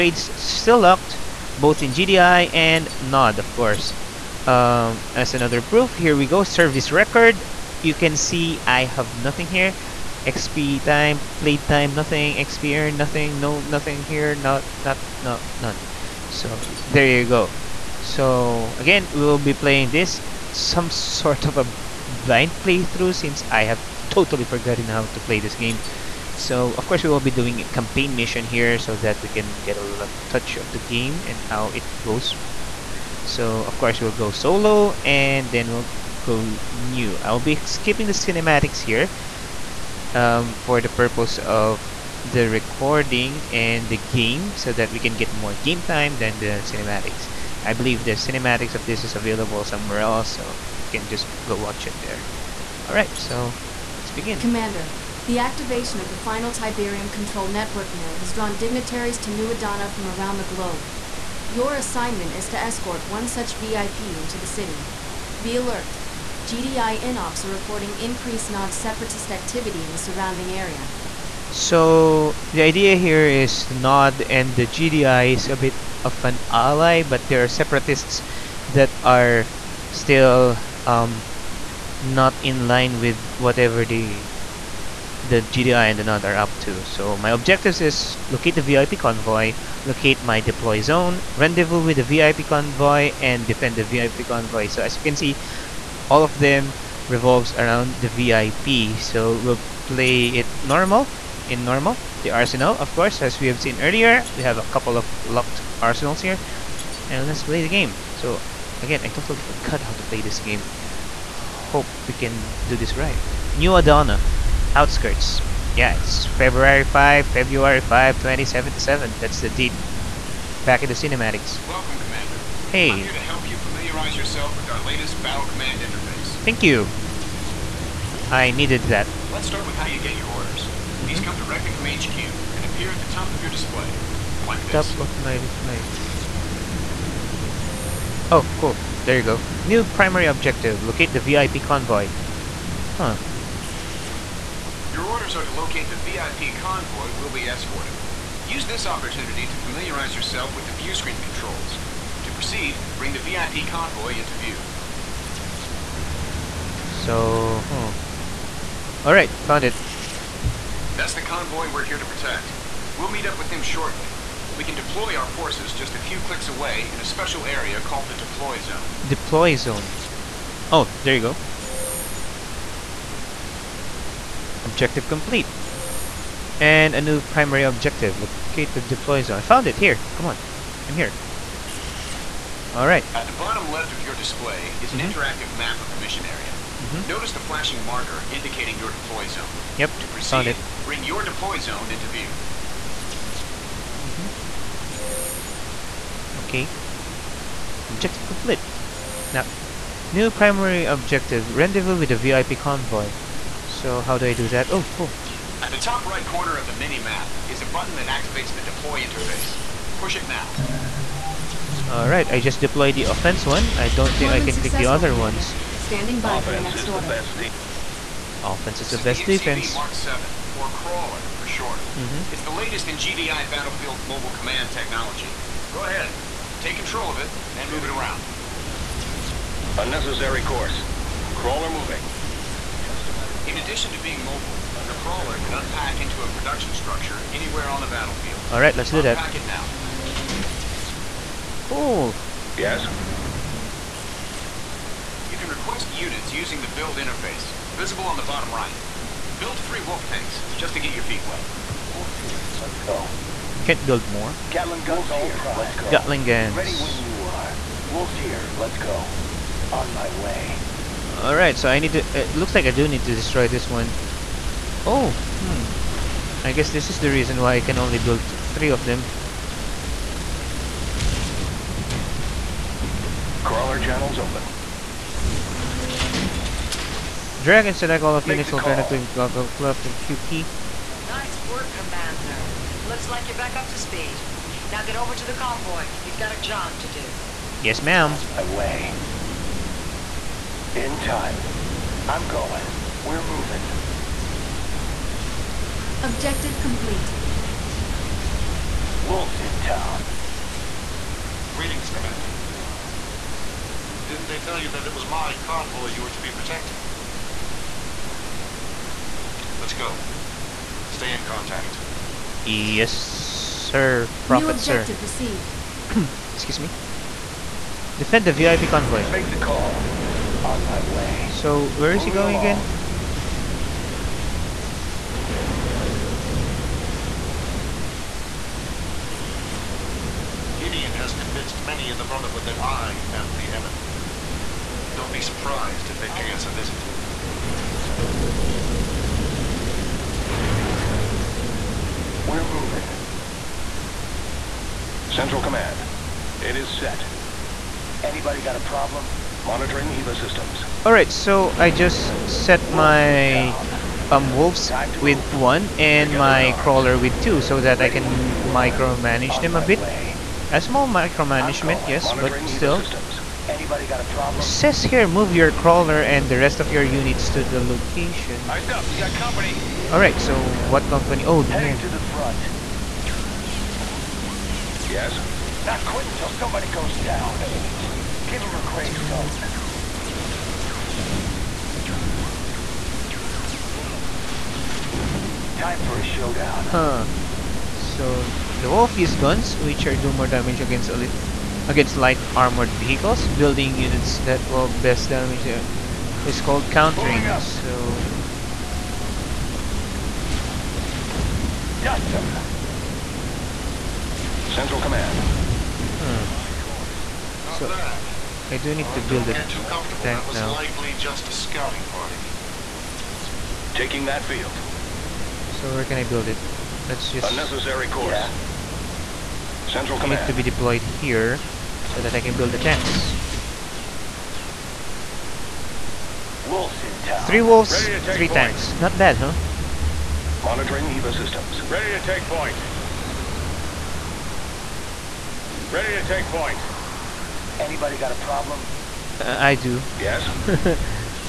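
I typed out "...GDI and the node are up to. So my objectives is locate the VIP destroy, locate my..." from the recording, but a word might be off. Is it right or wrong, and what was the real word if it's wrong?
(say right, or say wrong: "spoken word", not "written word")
wrong: "convoy", not "destroy".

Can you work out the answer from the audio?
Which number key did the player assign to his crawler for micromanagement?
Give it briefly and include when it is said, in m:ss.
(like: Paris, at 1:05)
2, at 5:57.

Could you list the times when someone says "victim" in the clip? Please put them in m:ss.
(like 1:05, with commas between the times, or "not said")
not said.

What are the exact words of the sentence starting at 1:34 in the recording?
So as you can see, all of them revolves around the VIP.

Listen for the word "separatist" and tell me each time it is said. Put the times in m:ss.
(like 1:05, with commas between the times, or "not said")
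1:08, 1:17.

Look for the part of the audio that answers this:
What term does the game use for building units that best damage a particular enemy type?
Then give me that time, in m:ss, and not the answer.
6:36.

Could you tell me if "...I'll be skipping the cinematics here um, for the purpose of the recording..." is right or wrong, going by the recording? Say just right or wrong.
right.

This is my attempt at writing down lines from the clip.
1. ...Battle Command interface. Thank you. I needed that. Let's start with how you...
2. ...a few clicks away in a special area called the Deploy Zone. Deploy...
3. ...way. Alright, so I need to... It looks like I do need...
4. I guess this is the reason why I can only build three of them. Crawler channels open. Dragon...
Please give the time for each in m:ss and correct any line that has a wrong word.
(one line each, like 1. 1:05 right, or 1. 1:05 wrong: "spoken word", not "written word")
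1. 2:05 right
2. 2:45 right
3. 4:20 right
4. 4:26 right.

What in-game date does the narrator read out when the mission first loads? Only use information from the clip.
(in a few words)
February 5, 2077.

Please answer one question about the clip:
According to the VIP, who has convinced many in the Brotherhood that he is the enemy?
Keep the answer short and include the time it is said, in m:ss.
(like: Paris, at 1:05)
Gideon, at 5:30.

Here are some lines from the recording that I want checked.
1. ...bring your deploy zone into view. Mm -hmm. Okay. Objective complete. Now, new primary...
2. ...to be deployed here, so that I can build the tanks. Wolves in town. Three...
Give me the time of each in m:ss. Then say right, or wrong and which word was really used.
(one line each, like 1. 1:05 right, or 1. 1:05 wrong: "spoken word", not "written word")
1. 3:10 right
2. 7:00 right.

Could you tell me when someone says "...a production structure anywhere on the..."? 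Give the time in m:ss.
3:56.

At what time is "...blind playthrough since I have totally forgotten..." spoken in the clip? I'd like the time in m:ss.
0:22.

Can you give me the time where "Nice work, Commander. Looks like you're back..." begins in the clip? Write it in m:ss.
4:41.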